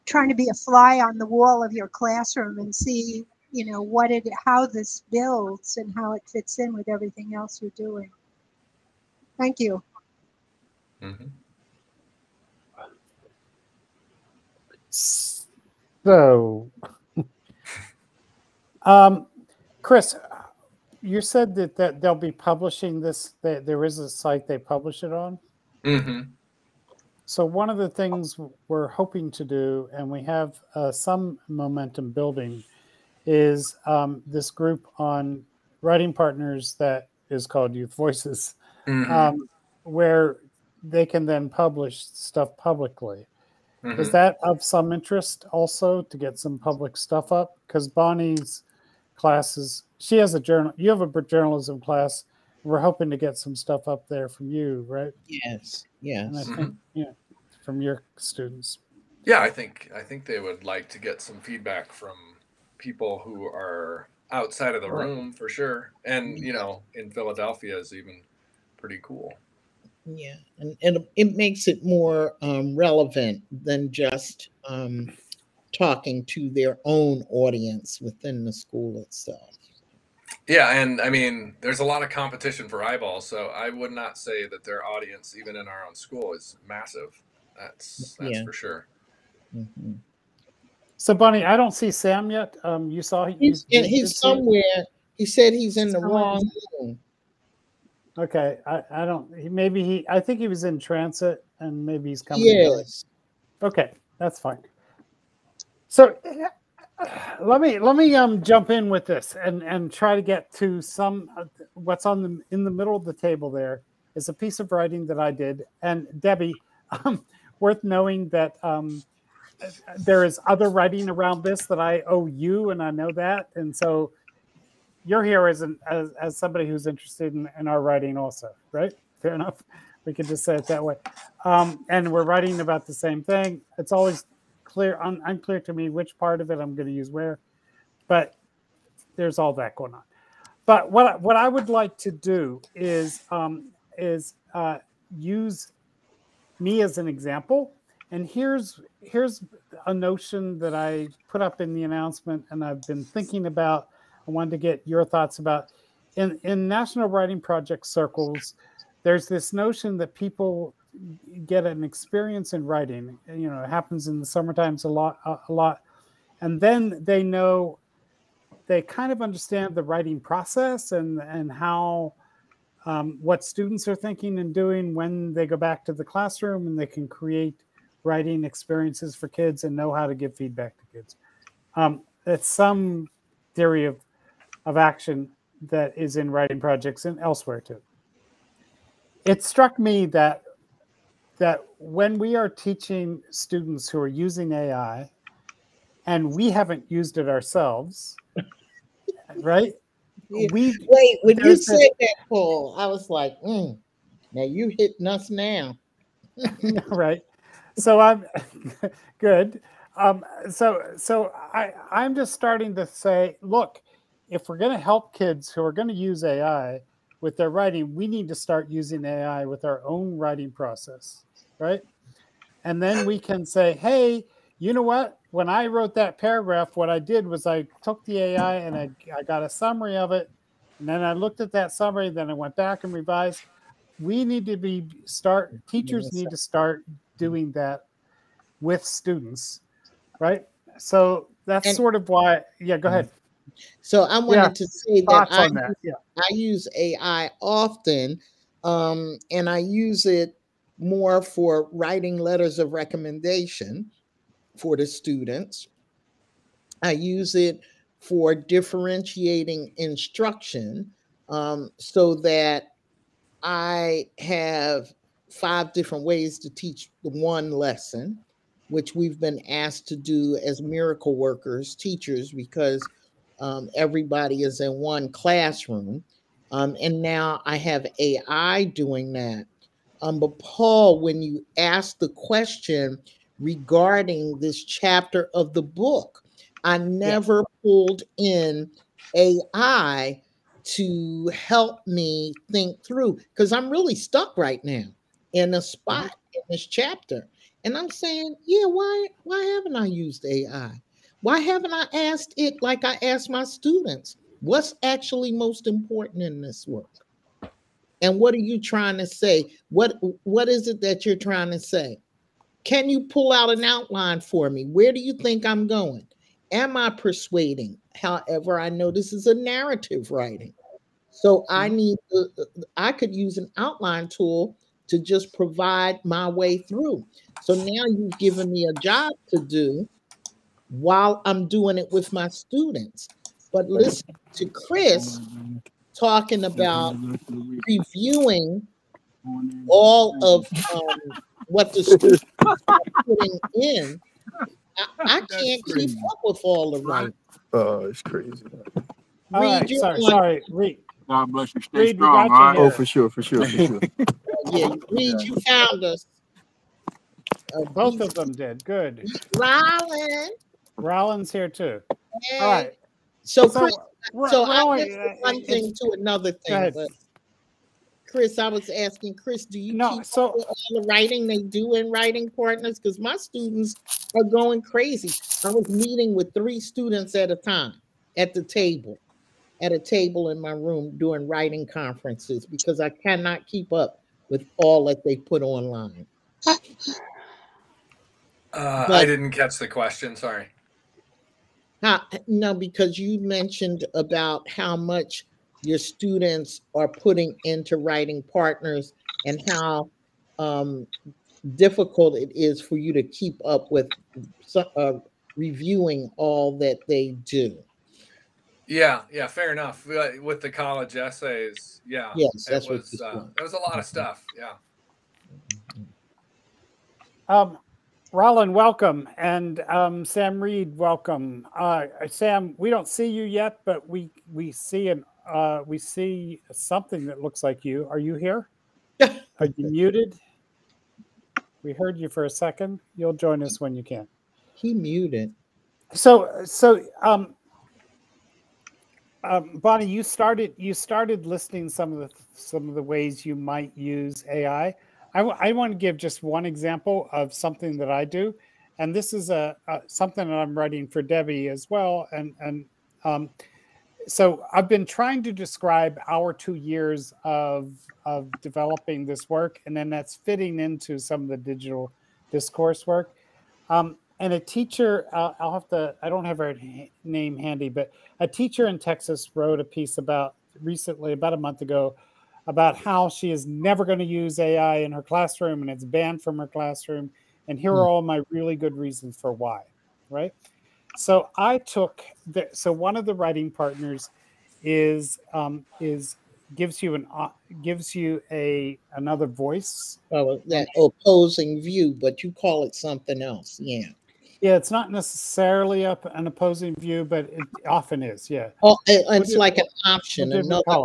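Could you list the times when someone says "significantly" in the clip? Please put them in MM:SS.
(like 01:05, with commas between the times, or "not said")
not said.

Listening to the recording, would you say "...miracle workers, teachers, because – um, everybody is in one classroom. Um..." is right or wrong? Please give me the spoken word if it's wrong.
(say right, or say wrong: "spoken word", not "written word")
right.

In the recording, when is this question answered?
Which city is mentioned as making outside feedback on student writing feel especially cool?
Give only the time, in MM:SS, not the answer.
01:07.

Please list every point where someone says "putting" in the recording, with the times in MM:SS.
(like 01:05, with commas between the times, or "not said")
05:43, 06:36.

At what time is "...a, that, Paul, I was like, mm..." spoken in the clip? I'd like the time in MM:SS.
03:21.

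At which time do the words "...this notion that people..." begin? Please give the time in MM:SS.
02:39.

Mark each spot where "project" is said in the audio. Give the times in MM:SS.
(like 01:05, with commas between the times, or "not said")
02:37, 03:06.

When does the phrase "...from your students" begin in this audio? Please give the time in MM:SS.
00:57.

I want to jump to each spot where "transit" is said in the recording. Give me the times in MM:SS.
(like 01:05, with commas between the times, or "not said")
01:40.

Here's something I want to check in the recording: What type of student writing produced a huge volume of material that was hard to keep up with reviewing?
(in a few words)
college essays.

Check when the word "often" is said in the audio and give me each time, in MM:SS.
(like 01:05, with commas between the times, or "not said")
04:07, 08:17.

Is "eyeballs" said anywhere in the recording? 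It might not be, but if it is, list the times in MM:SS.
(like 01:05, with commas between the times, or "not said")
01:22.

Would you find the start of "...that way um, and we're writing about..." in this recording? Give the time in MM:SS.
02:10.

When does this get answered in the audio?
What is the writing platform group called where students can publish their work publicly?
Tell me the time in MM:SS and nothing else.
00:37.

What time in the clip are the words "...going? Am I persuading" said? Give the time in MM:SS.
05:15.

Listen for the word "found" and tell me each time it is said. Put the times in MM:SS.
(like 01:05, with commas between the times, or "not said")
05:55.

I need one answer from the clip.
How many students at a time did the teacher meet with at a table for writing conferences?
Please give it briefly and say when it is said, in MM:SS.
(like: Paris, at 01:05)
3, at 06:16.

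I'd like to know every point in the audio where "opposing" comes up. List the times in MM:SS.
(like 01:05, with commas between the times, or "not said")
08:10, 08:16.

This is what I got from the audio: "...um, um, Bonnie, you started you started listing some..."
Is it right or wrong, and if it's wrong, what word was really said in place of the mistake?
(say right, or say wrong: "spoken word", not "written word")
right.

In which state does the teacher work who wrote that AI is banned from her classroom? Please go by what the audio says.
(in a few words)
Texas.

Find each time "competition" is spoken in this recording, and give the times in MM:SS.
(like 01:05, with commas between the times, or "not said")
01:22.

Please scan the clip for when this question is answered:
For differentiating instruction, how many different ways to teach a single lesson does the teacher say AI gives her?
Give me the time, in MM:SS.
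04:25.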